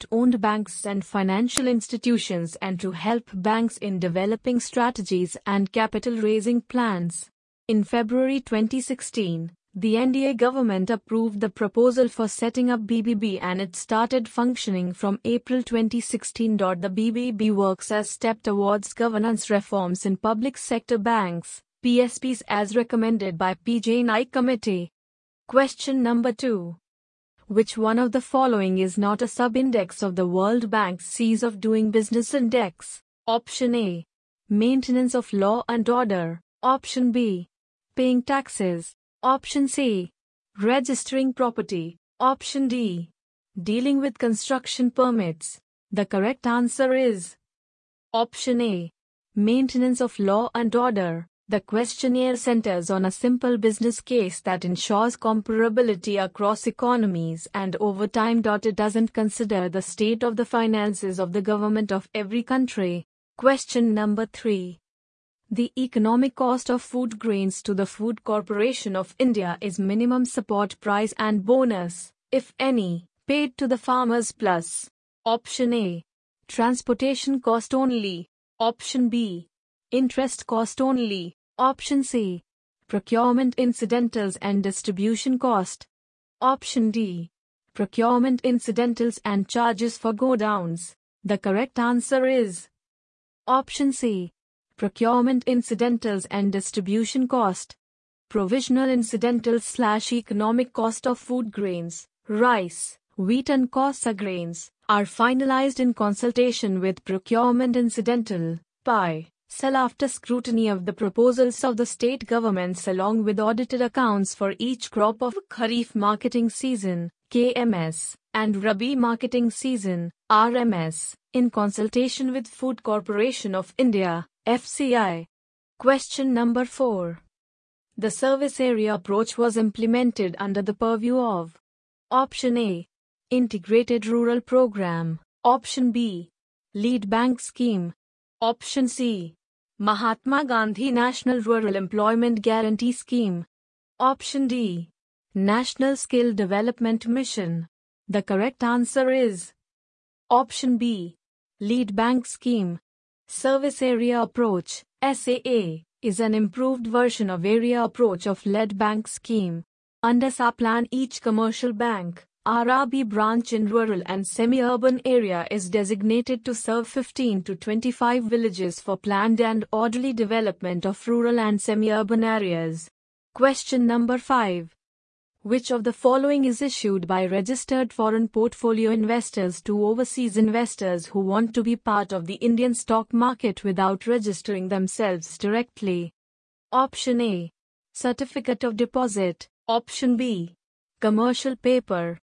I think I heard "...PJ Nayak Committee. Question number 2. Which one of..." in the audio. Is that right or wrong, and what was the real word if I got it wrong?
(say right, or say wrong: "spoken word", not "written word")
right.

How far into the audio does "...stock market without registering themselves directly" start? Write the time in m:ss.
3:02.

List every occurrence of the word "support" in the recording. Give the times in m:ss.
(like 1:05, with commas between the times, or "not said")
1:10.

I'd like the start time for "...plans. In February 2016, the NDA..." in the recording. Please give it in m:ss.
0:06.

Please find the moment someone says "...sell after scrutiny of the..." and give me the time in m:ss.
1:49.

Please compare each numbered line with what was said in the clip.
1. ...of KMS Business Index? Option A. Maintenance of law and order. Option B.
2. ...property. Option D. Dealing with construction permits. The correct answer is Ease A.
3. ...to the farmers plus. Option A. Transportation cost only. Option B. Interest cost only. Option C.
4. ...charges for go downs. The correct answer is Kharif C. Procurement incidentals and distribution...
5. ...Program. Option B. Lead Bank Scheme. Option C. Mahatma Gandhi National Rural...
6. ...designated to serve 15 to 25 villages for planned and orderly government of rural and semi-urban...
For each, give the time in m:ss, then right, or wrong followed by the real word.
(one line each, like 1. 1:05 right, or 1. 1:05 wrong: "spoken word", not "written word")
1. 0:31 wrong: "Doing", not "KMS"
2. 0:41 wrong: "Option", not "Ease"
3. 1:13 right
4. 1:29 wrong: "Option", not "Kharif"
5. 2:14 right
6. 2:45 wrong: "development", not "government".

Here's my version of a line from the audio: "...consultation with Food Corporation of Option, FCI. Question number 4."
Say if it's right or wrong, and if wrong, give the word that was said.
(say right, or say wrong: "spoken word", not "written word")
wrong: "India", not "Option".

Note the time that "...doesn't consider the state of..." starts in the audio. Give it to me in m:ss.
0:58.